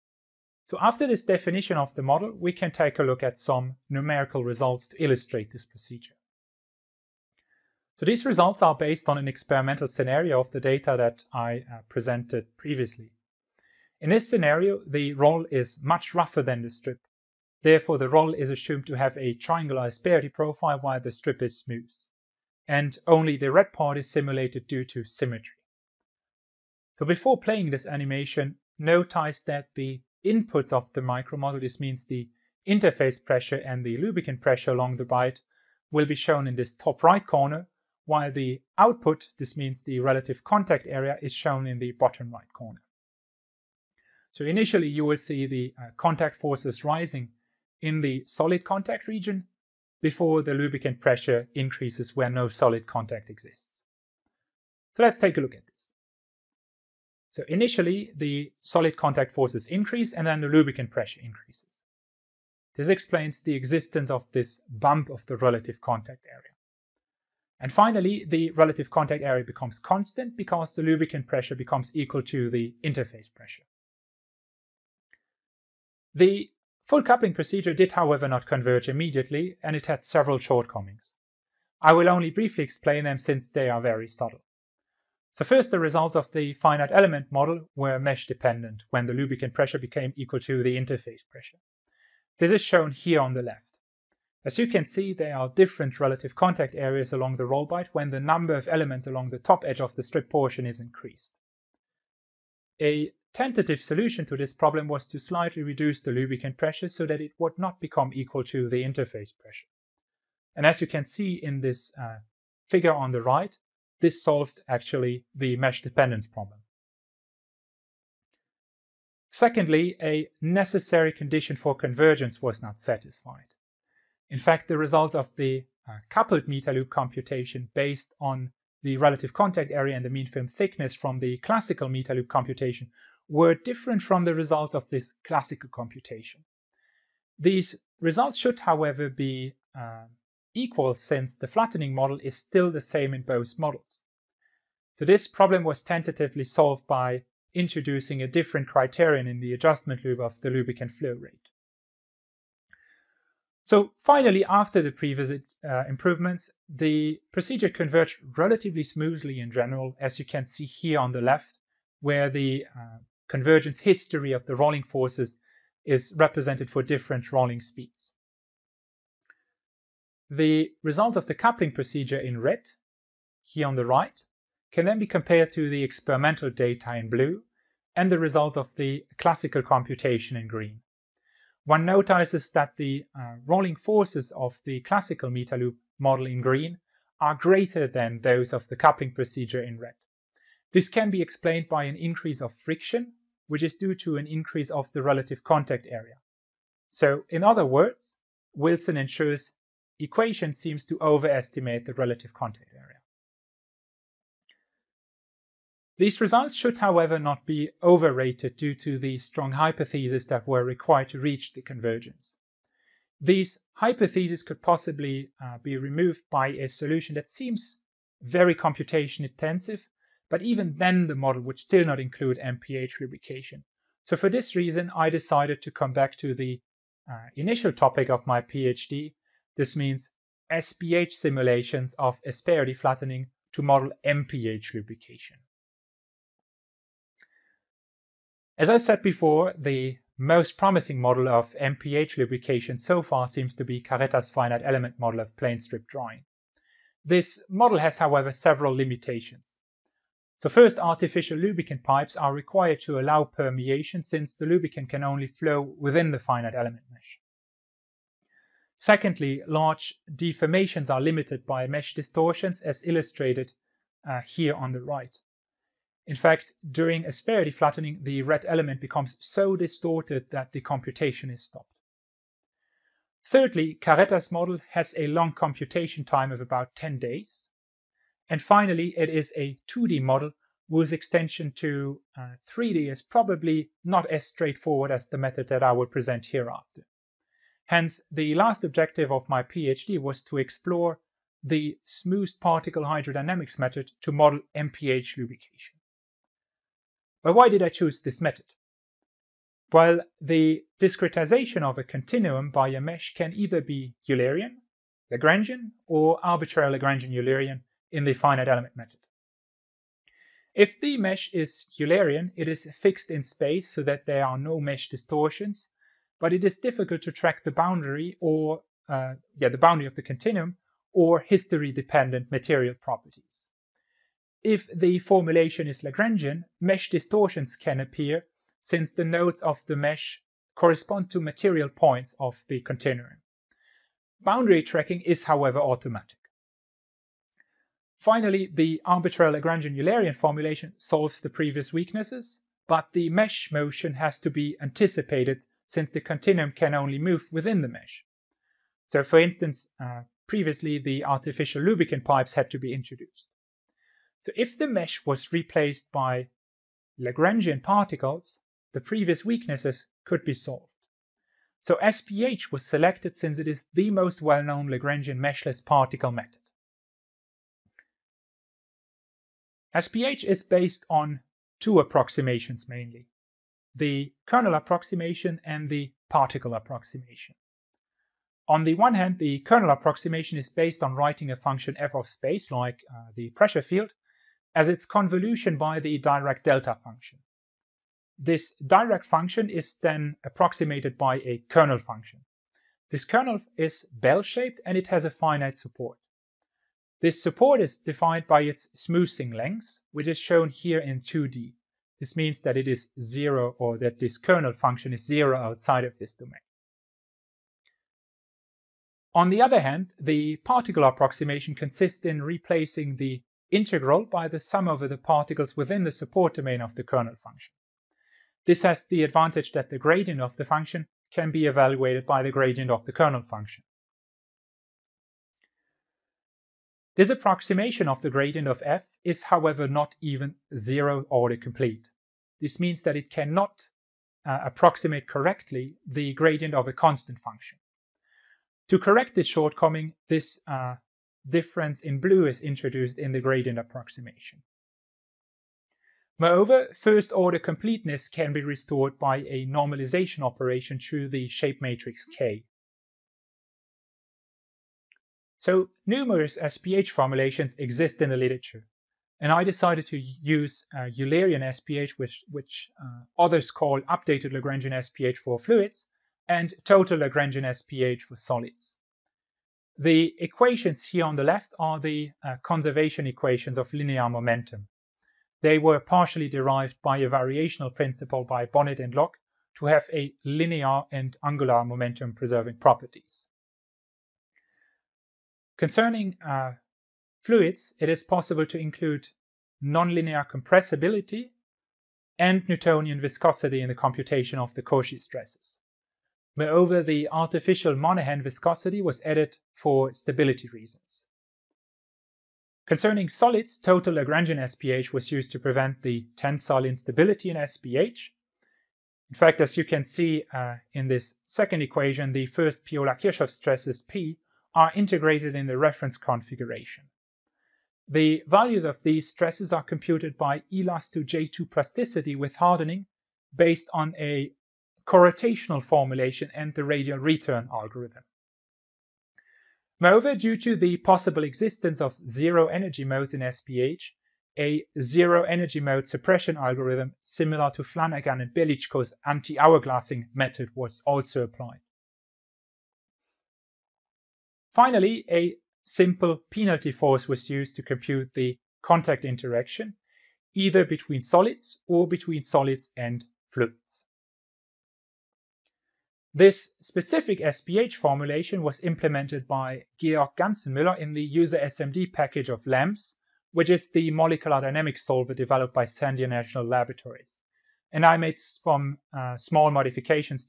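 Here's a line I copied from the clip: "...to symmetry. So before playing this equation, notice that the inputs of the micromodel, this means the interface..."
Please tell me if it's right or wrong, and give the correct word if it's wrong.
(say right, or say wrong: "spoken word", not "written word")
wrong: "animation", not "equation".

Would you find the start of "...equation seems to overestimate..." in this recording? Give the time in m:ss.
3:19.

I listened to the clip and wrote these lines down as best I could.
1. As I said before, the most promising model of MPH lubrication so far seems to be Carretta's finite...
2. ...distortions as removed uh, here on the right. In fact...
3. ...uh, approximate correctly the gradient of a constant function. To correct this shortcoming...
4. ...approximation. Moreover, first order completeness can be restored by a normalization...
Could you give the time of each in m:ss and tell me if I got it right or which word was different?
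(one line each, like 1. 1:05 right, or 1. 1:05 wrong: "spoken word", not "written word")
1. 3:58 right
2. 4:21 wrong: "illustrated", not "removed"
3. 7:14 right
4. 7:23 right.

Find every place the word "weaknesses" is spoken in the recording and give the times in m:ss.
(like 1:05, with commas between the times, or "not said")
5:41, 5:59.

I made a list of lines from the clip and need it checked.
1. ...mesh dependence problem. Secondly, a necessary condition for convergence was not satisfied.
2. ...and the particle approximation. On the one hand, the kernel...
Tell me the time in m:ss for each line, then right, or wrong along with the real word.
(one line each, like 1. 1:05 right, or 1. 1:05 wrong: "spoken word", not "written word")
1. 1:55 right
2. 6:15 right.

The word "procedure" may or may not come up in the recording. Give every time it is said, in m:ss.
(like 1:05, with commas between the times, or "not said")
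0:05, 1:17, 2:37, 2:51, 3:09.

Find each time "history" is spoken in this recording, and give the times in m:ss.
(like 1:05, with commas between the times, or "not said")
2:43, 5:21.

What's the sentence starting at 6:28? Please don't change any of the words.
This Dirac function is then approximated by a kernel function.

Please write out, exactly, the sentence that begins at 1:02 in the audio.
This explains the existence of this bump of the relative contact area.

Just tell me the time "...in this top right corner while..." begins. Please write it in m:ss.
0:36.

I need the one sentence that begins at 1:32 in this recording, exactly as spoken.
This is shown here on the left.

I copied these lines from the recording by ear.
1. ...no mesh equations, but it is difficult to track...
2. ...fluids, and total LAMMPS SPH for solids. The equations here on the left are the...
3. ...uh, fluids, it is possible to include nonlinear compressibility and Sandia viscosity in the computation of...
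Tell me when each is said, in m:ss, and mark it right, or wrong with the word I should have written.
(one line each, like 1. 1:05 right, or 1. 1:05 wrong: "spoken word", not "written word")
1. 5:14 wrong: "distortions", not "equations"
2. 7:45 wrong: "Lagrangian", not "LAMMPS"
3. 8:06 wrong: "Newtonian", not "Sandia".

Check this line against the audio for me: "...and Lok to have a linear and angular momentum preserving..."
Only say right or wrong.
right.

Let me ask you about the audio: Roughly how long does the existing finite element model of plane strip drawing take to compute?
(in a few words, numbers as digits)
About 10 days.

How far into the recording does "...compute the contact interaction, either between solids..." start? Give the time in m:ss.
9:07.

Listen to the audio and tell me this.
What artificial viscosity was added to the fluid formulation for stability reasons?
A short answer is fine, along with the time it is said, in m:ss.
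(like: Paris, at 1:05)
Monaghan viscosity, at 8:17.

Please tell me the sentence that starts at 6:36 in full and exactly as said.
This support is defined by its smoothing length, which is shown here in 2D.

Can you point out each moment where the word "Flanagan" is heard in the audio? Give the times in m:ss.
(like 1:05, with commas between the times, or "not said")
8:57.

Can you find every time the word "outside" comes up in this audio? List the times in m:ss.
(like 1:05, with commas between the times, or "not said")
6:45.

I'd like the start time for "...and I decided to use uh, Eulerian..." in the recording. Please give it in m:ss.
7:39.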